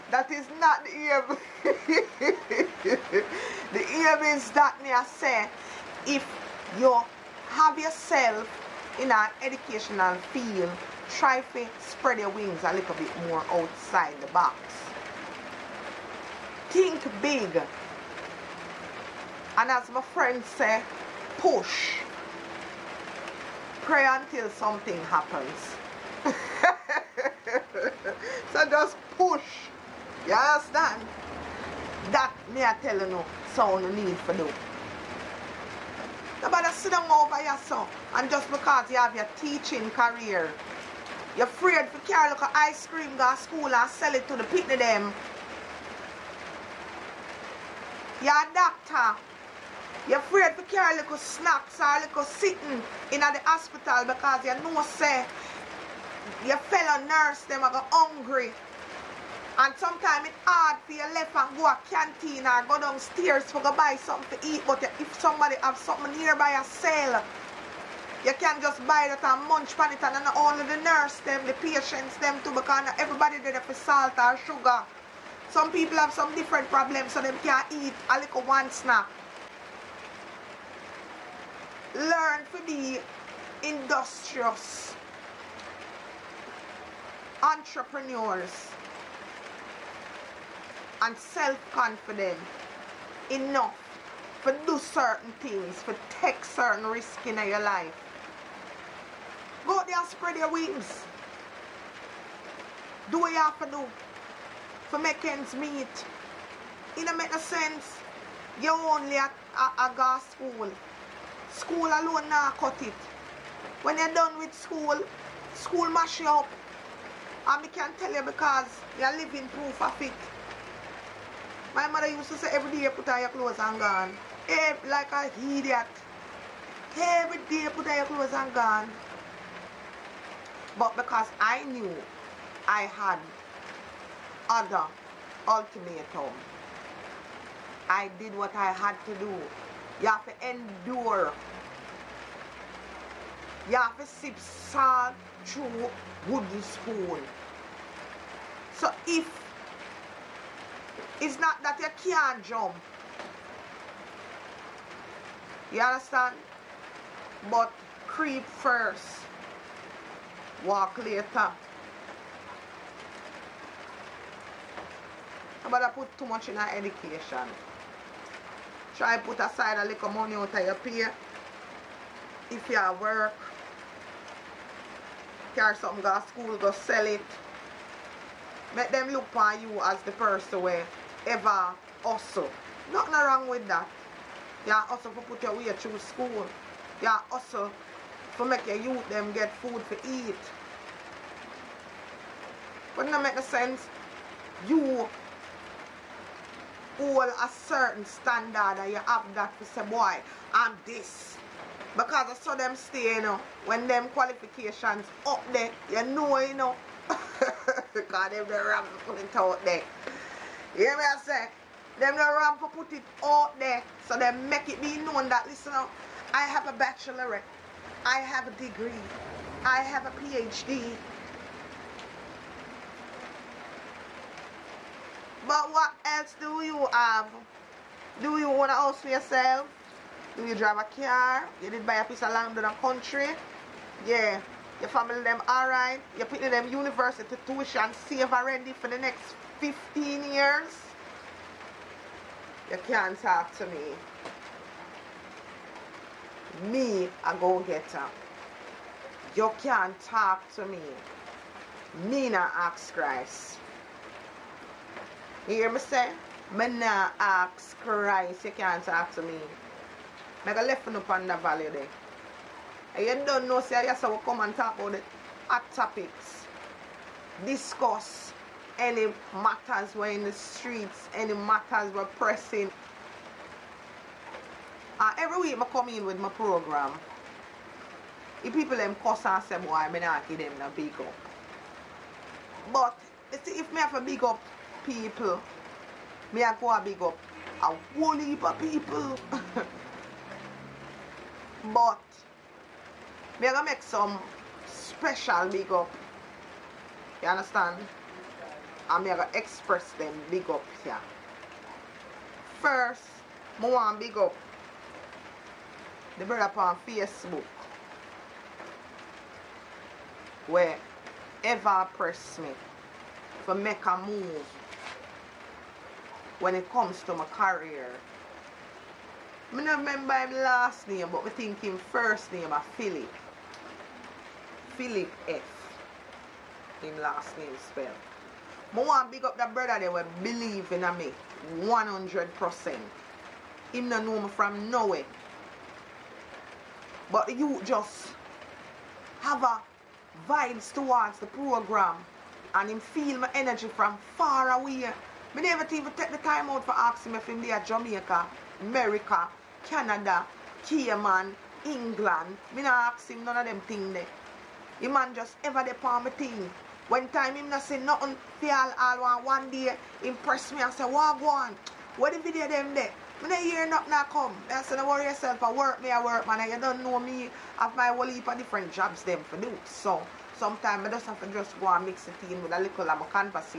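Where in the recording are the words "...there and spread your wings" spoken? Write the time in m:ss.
1:39.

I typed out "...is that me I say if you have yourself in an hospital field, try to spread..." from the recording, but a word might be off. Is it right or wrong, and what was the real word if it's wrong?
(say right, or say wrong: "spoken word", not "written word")
wrong: "educational", not "hospital".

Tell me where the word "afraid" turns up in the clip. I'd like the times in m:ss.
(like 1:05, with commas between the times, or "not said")
0:41, 0:50.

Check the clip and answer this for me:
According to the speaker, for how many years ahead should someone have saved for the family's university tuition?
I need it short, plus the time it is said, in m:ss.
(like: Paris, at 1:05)
15, at 3:59.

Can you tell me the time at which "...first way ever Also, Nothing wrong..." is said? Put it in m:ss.
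3:00.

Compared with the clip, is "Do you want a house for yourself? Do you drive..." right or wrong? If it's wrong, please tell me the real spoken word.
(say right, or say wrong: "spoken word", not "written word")
right.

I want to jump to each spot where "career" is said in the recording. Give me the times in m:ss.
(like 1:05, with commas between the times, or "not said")
0:39, 5:17.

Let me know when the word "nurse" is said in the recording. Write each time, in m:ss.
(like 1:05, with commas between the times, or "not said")
0:57, 1:10.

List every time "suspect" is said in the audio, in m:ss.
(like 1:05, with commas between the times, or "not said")
not said.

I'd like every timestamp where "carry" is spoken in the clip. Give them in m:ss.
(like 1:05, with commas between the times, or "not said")
0:42, 0:50, 2:55.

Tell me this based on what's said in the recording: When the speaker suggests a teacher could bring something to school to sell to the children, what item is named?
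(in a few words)
ice cream.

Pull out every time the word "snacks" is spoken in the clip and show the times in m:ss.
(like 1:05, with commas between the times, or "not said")
0:51, 1:18.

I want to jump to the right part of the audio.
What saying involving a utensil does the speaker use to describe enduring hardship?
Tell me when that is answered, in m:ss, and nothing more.
2:24.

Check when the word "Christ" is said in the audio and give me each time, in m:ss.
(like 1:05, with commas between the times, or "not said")
4:12, 4:17.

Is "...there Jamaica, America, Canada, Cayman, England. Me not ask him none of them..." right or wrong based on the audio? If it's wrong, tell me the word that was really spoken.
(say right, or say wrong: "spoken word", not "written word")
right.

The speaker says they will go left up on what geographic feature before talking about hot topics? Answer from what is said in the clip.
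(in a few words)
the valley.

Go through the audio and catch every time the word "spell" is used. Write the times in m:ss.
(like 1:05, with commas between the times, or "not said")
5:27.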